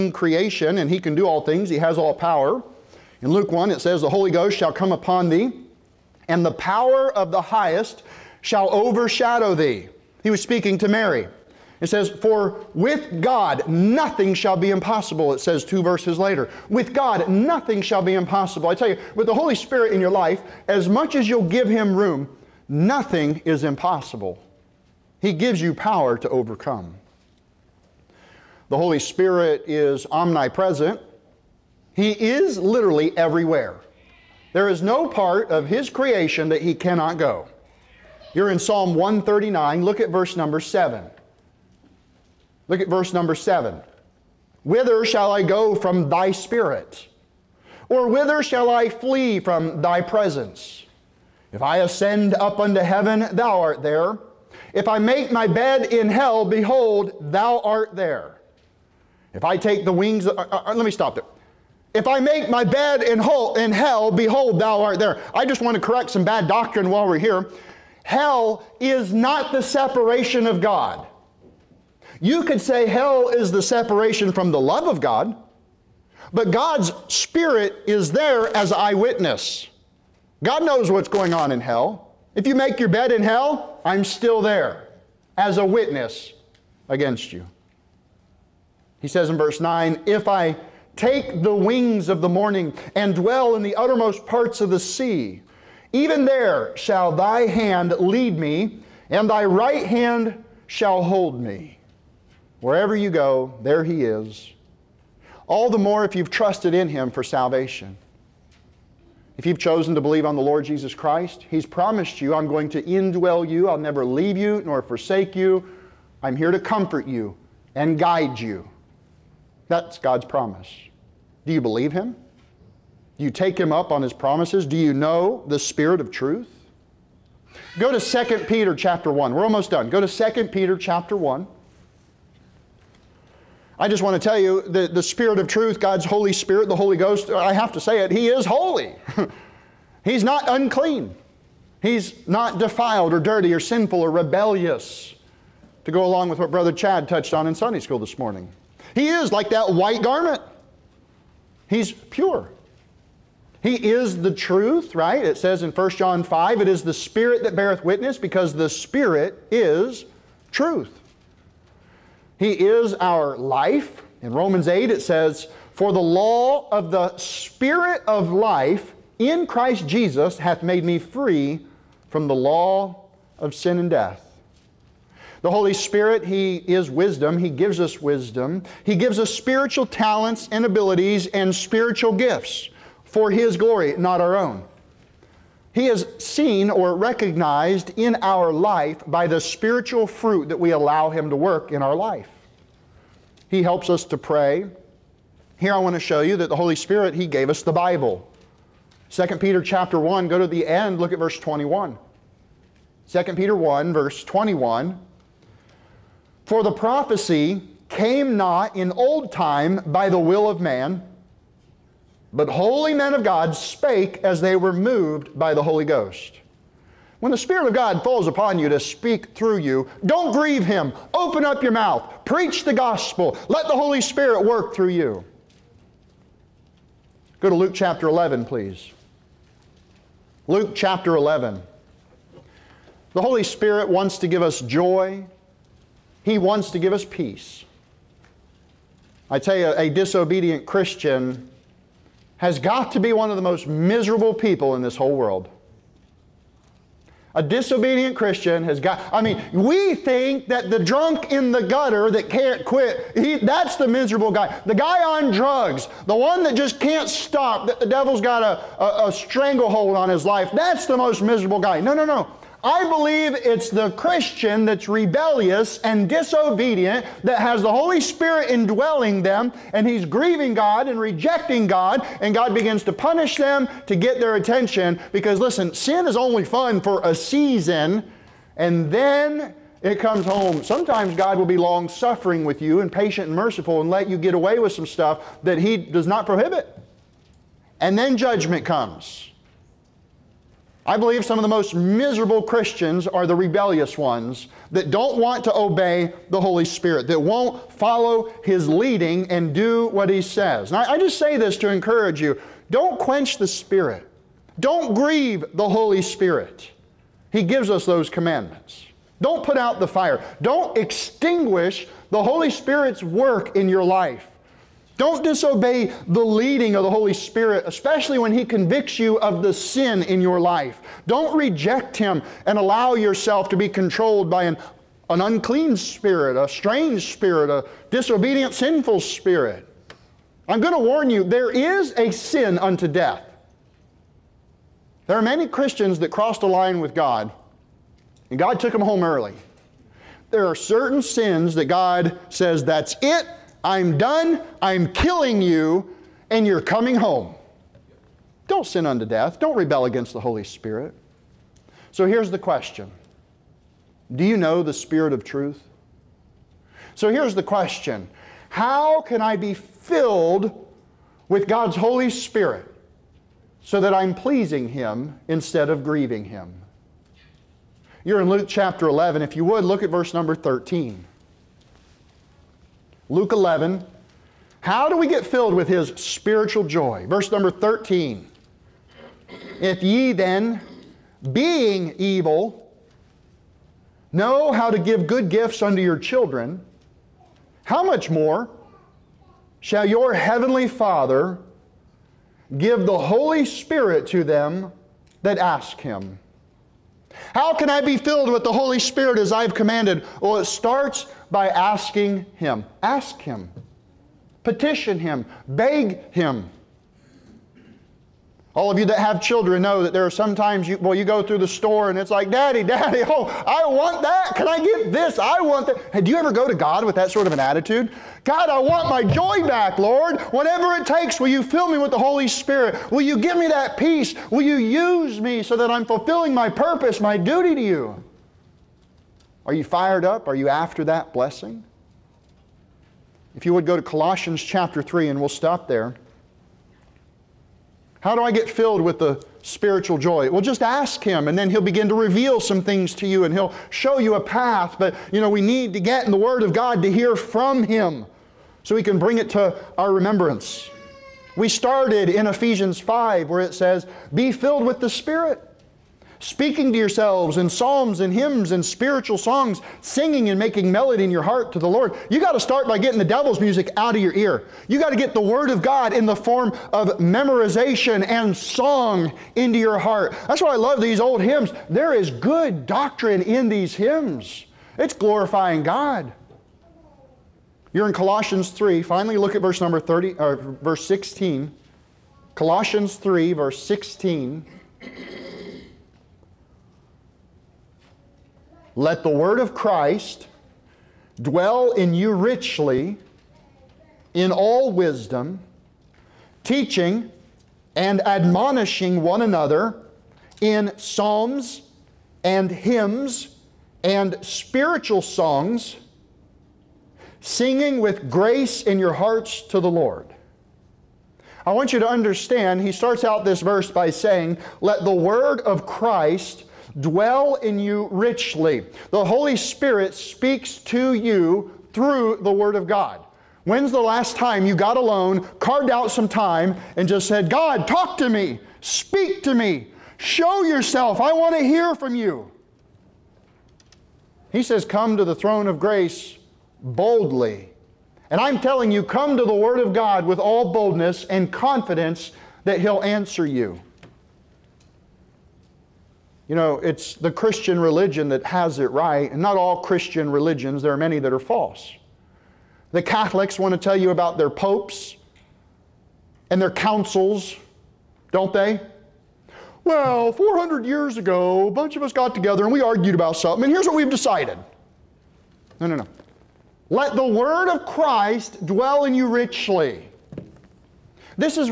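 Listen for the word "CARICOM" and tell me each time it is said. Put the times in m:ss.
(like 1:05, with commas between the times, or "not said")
not said.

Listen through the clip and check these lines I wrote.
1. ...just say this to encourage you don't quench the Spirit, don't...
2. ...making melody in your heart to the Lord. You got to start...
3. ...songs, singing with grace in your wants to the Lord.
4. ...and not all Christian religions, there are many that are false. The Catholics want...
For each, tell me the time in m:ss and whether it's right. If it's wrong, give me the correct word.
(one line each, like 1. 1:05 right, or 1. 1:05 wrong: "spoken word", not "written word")
1. 5:00 right
2. 7:40 right
3. 8:25 wrong: "hearts", not "wants"
4. 9:09 right.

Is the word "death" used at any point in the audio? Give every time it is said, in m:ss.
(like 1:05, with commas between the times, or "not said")
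2:53, 5:32, 5:49.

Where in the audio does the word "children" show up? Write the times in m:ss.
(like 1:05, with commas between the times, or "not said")
6:25, 6:49.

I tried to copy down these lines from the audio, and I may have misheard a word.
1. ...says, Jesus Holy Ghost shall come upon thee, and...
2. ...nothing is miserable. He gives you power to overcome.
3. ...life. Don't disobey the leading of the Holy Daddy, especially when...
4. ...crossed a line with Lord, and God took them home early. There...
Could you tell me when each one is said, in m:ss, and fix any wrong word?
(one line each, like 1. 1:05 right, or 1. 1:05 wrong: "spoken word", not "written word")
1. 0:03 wrong: "The", not "Jesus"
2. 0:22 wrong: "impossible", not "miserable"
3. 5:13 wrong: "Spirit", not "Daddy"
4. 5:36 wrong: "God", not "Lord".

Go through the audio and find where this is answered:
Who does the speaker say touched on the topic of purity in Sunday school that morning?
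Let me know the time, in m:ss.
2:26.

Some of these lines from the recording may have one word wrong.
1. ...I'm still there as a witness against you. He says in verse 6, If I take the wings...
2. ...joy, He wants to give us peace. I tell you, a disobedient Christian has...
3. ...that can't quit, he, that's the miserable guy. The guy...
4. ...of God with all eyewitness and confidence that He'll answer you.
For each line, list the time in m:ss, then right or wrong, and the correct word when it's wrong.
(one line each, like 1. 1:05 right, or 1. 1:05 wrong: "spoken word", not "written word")
1. 1:23 wrong: "9", not "6"
2. 3:54 right
3. 4:12 right
4. 8:59 wrong: "boldness", not "eyewitness".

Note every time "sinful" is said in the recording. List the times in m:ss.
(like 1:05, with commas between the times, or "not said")
2:23, 5:28.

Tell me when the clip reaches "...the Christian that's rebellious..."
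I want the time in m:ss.
4:23.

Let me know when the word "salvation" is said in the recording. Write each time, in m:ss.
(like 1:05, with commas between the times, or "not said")
1:47.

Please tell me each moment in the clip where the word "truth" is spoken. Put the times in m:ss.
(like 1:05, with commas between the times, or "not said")
2:06, 2:15, 2:34, 2:40, 5:55.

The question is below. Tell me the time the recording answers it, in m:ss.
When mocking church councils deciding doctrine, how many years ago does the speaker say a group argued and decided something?
9:20.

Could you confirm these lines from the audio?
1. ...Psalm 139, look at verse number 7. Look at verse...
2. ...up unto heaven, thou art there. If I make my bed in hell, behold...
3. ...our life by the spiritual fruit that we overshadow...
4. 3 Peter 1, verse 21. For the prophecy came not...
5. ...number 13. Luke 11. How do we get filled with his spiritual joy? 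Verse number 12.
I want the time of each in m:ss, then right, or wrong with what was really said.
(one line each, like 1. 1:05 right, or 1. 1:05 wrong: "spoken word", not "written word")
1. 0:38 right
2. 0:52 right
3. 3:08 wrong: "allow", not "overshadow"
4. 3:23 wrong: "2", not "3"
5. 6:10 wrong: "13", not "12".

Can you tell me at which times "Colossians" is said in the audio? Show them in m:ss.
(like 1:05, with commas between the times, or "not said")
7:13, 7:57, 8:02.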